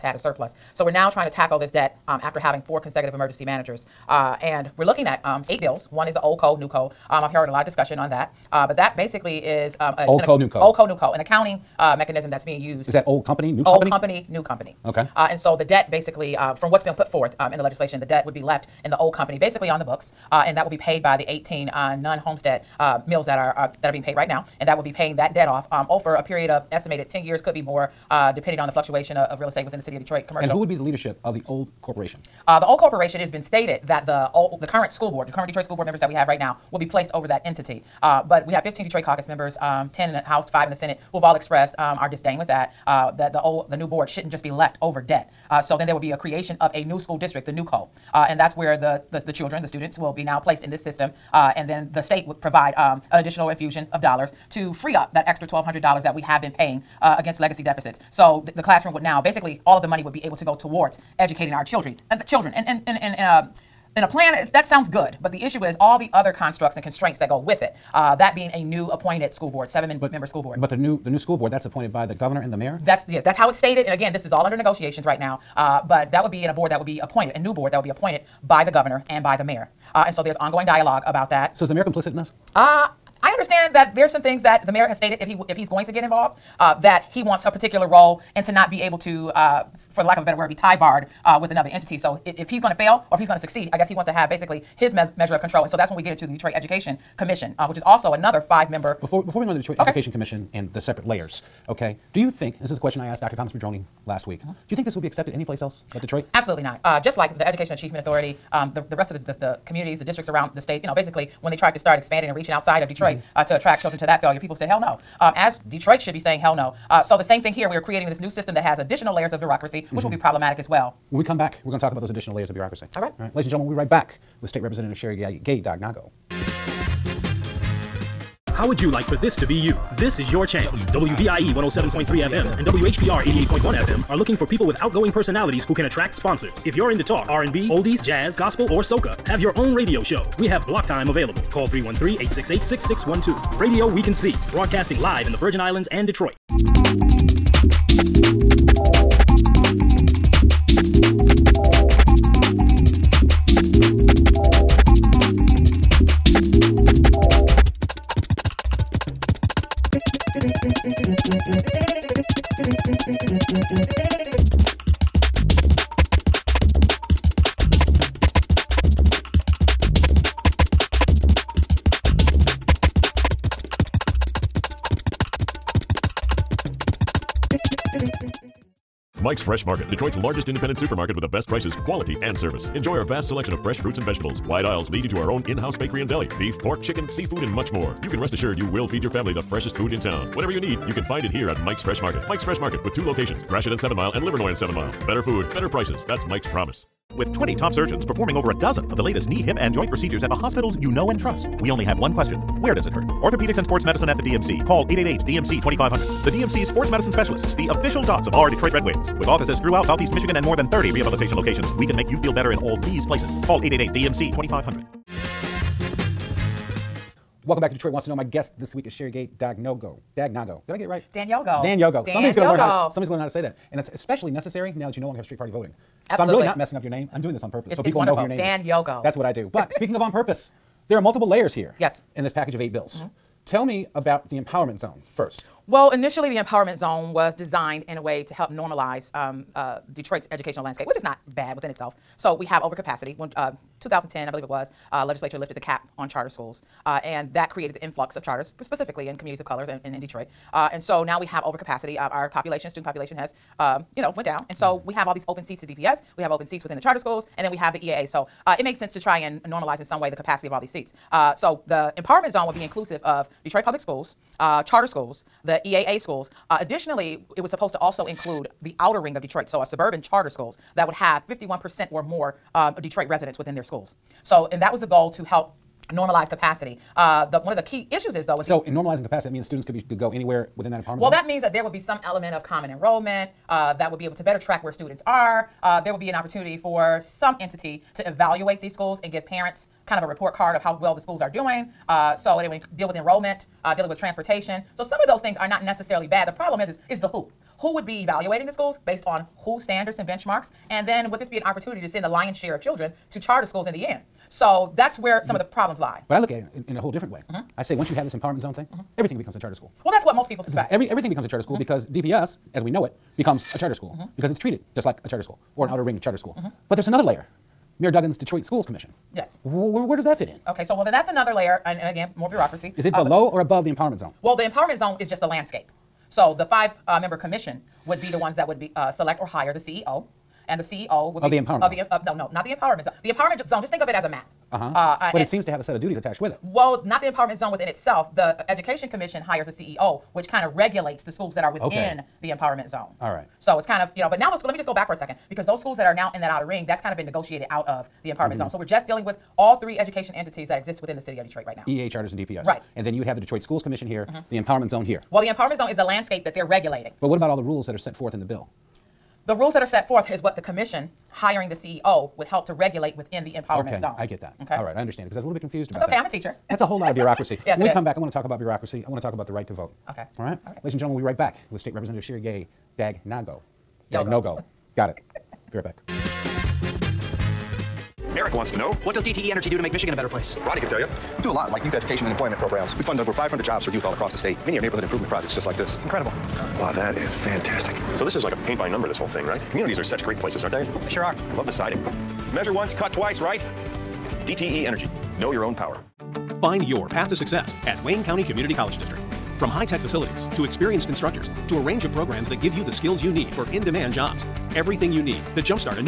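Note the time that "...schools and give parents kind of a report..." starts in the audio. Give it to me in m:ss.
4:48.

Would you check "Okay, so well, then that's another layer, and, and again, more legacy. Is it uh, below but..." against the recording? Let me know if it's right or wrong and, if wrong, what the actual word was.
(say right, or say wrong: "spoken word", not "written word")
wrong: "bureaucracy", not "legacy".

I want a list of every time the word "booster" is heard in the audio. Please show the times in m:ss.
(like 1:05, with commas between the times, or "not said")
not said.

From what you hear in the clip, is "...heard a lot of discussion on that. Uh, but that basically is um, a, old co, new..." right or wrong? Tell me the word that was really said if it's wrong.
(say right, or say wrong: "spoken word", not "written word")
right.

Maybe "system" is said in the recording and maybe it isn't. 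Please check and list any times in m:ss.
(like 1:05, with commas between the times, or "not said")
0:50, 1:58.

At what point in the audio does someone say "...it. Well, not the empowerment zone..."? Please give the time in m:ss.
5:36.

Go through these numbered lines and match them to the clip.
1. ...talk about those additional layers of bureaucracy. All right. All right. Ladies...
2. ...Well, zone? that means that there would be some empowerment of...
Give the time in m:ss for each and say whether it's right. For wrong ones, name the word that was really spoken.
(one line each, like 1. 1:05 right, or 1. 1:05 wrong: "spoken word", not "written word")
1. 2:01 right
2. 4:41 wrong: "element", not "empowerment".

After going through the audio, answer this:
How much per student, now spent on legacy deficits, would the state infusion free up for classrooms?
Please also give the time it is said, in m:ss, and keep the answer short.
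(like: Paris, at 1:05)
$1,200, at 0:55.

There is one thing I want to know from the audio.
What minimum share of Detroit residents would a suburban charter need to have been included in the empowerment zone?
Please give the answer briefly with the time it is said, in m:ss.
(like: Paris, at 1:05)
51%, at 4:31.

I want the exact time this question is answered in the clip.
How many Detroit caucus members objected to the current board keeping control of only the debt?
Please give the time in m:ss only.
0:38.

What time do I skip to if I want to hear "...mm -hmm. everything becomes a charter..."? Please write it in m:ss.
5:08.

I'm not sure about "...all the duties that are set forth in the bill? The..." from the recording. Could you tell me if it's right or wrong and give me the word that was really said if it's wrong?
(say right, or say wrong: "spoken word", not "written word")
wrong: "rules", not "duties".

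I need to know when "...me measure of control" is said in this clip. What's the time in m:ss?
1:34.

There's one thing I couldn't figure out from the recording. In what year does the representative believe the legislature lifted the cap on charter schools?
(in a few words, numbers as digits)
2010.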